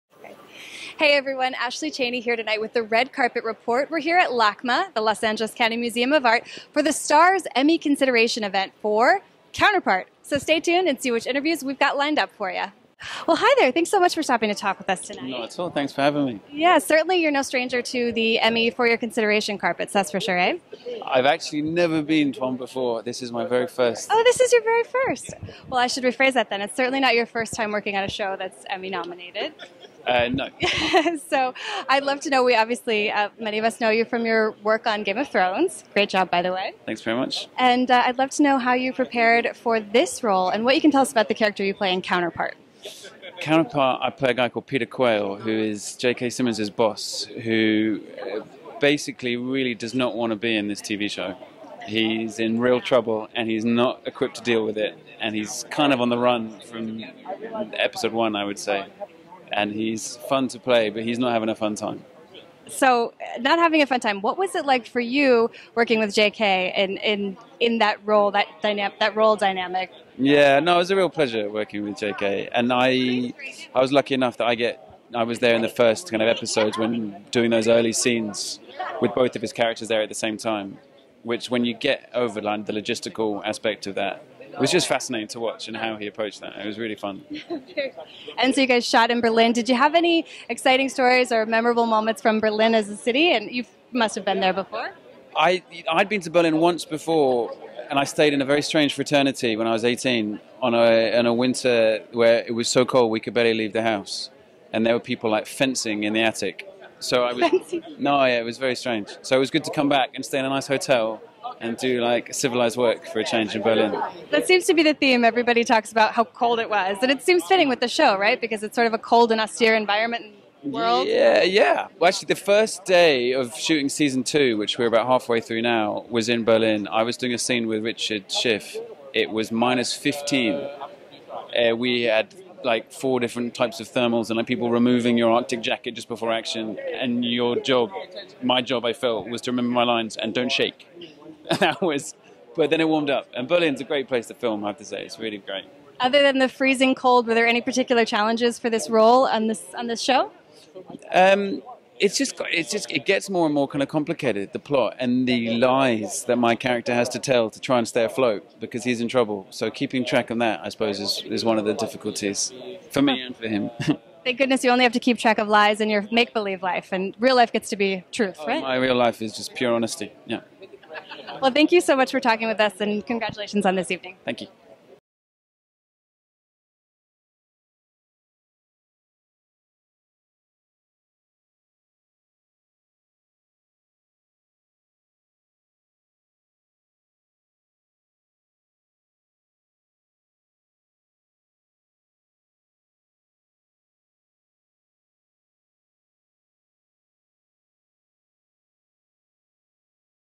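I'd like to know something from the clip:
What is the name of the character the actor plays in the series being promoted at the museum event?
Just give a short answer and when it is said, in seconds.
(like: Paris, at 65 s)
Peter Quayle, at 44 s.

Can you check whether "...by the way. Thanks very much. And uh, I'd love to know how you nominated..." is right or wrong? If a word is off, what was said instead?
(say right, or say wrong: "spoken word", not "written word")
wrong: "prepared", not "nominated".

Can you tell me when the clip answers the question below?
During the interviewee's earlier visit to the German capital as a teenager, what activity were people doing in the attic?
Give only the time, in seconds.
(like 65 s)
105 s.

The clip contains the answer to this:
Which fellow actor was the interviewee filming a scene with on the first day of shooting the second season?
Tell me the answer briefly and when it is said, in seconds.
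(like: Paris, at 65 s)
Richard Schiff, at 127 s.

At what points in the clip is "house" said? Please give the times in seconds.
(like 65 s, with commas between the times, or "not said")
103 s.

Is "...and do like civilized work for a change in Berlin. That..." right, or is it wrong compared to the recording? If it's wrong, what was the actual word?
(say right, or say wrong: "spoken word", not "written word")
right.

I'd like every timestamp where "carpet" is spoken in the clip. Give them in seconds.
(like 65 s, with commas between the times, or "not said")
3 s, 19 s.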